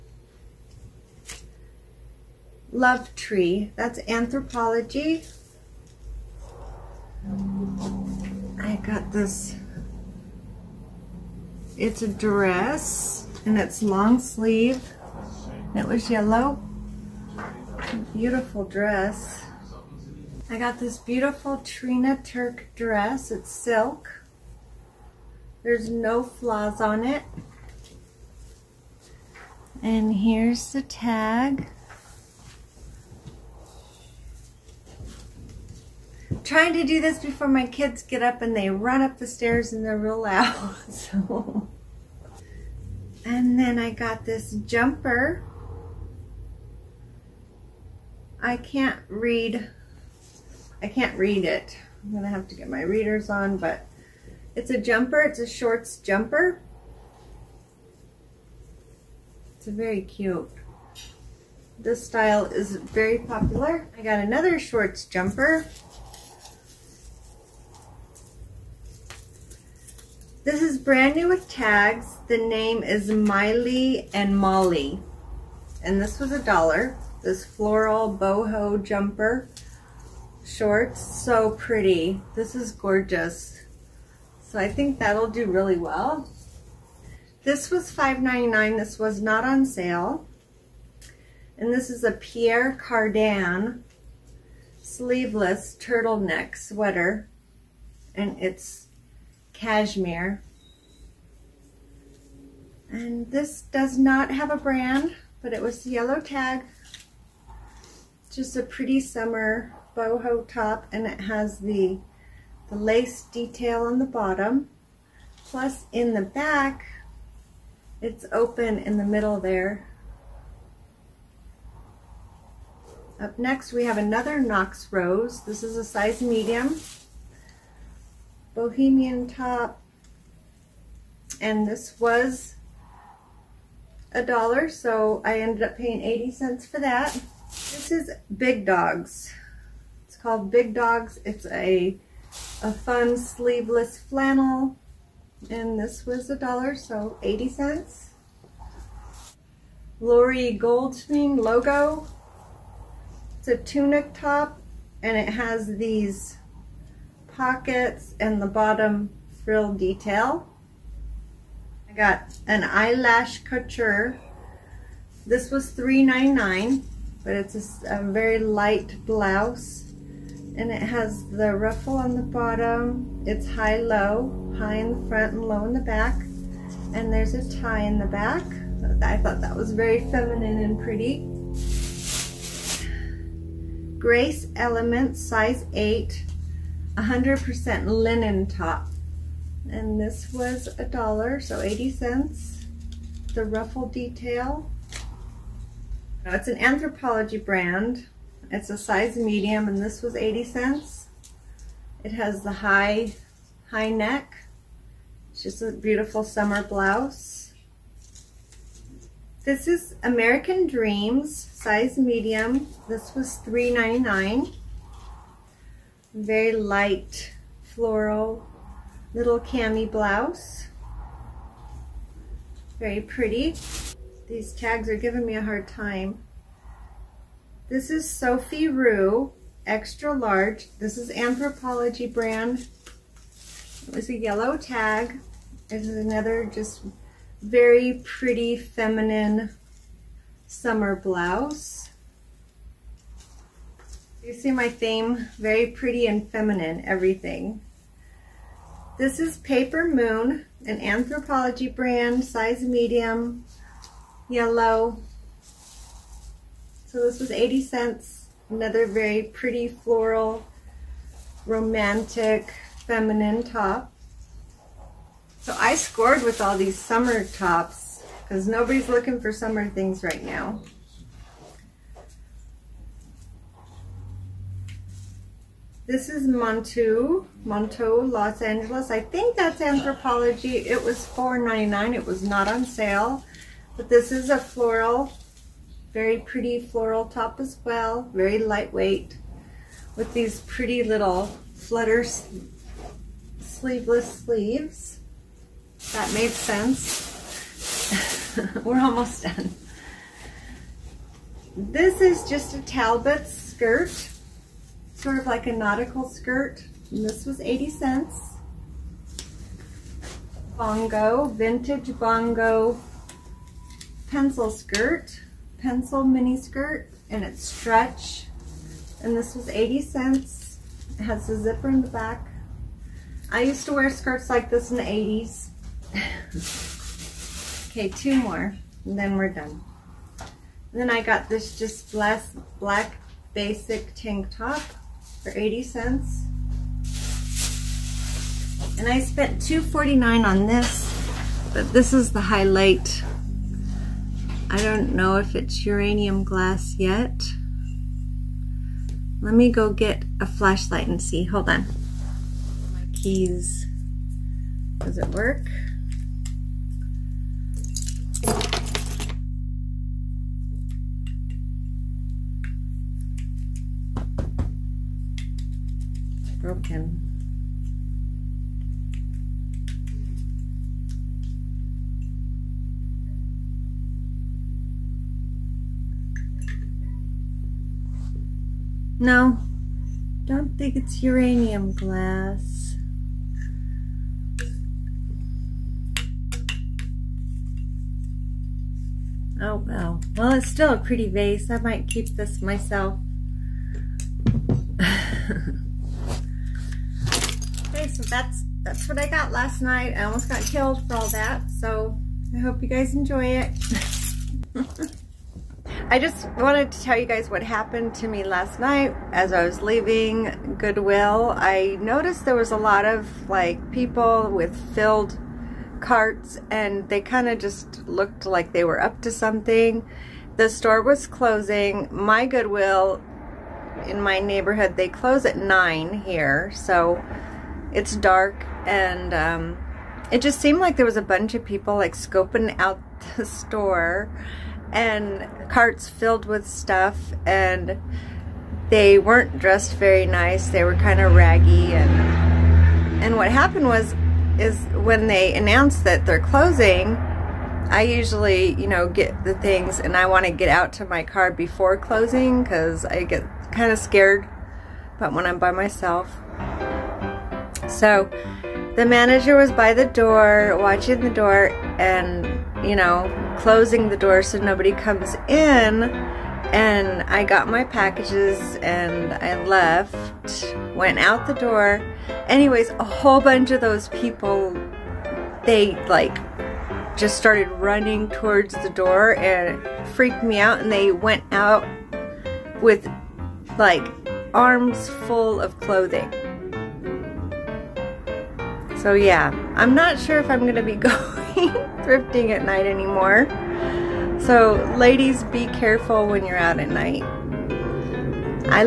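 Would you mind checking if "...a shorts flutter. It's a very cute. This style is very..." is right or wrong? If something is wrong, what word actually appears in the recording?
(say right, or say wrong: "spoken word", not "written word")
wrong: "jumper", not "flutter".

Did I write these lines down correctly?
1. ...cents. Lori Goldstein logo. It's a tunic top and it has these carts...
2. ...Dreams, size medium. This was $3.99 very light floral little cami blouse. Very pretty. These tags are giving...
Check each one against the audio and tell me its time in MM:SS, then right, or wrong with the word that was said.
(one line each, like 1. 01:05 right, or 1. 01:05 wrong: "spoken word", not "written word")
1. 02:27 wrong: "pockets", not "carts"
2. 03:30 right.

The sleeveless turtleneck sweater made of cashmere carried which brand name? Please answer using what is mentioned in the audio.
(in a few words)
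Pierre Cardin.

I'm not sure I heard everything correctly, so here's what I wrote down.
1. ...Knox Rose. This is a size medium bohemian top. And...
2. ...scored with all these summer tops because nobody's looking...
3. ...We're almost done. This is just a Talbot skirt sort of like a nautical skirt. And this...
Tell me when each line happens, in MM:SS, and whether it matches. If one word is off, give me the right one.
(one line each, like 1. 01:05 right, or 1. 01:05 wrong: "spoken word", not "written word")
1. 02:04 right
2. 04:25 right
3. 04:58 right.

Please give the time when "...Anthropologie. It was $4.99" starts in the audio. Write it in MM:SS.
04:39.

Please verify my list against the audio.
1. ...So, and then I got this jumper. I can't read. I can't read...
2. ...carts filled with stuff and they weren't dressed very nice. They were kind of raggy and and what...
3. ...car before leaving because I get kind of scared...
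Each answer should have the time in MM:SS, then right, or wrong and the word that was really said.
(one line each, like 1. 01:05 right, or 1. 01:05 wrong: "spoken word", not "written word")
1. 00:40 right
2. 07:15 right
3. 07:31 wrong: "closing", not "leaving".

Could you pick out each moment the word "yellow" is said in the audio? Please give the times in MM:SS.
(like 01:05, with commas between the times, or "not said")
00:16, 01:45, 03:54, 04:14.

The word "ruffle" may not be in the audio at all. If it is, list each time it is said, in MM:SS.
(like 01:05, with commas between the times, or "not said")
02:51, 03:13.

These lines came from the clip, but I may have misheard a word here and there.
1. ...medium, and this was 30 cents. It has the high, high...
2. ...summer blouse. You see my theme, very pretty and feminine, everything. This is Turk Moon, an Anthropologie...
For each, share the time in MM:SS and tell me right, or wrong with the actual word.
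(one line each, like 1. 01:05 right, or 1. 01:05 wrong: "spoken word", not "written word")
1. 03:19 wrong: "80", not "30"
2. 04:00 wrong: "Paper", not "Turk".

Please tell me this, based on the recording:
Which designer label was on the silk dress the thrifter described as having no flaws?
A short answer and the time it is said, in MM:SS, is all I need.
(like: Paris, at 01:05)
Trina Turk, at 00:21.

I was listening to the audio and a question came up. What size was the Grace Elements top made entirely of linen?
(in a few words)
8.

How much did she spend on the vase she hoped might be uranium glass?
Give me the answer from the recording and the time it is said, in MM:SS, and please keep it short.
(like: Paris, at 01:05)
$2.49, at 05:39.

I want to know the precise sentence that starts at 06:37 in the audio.
Okay, so that's that's what I got last night.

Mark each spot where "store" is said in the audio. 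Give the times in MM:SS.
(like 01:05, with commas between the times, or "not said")
07:00, 07:13.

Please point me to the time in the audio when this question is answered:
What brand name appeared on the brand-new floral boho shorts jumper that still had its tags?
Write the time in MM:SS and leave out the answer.
01:13.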